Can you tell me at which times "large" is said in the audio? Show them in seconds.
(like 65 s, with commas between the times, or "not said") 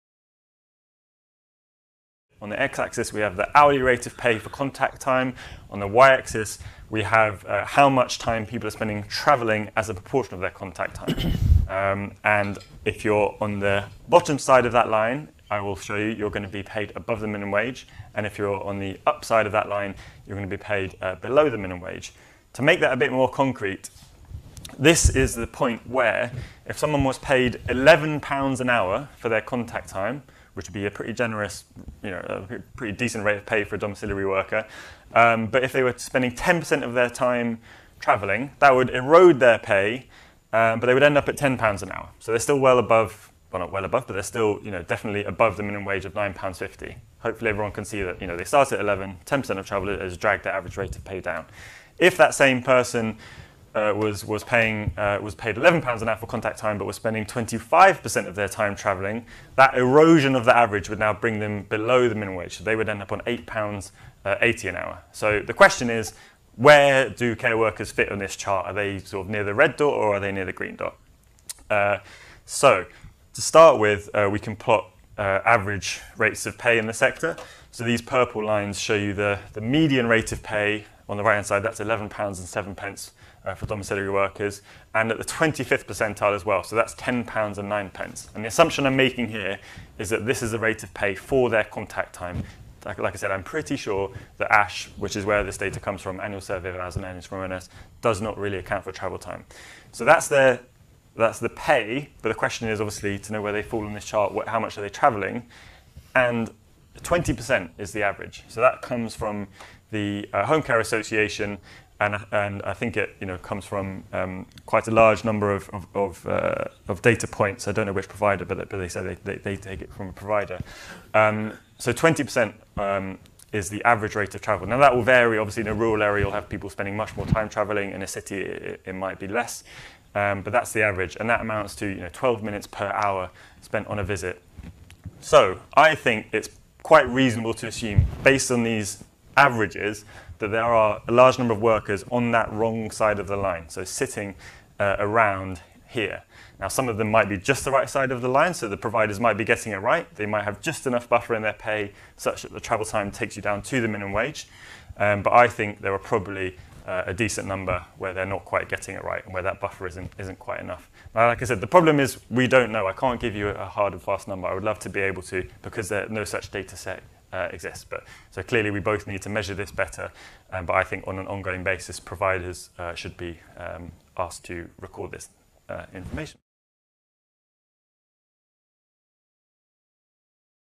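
114 s, 141 s.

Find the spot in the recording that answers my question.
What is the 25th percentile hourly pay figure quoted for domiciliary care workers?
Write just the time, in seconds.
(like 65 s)
86 s.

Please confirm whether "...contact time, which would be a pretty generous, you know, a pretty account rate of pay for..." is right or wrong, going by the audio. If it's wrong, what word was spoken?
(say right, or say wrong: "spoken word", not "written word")
wrong: "decent", not "account".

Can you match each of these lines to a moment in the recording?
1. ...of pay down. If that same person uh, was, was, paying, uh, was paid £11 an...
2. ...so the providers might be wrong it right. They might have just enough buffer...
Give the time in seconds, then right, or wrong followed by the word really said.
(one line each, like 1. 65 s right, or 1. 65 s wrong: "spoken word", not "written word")
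1. 50 s right
2. 148 s wrong: "getting", not "wrong".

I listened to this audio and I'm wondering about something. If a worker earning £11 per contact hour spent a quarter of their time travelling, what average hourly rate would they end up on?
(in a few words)
£8.80.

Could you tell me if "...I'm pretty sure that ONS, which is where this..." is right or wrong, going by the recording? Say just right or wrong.
wrong.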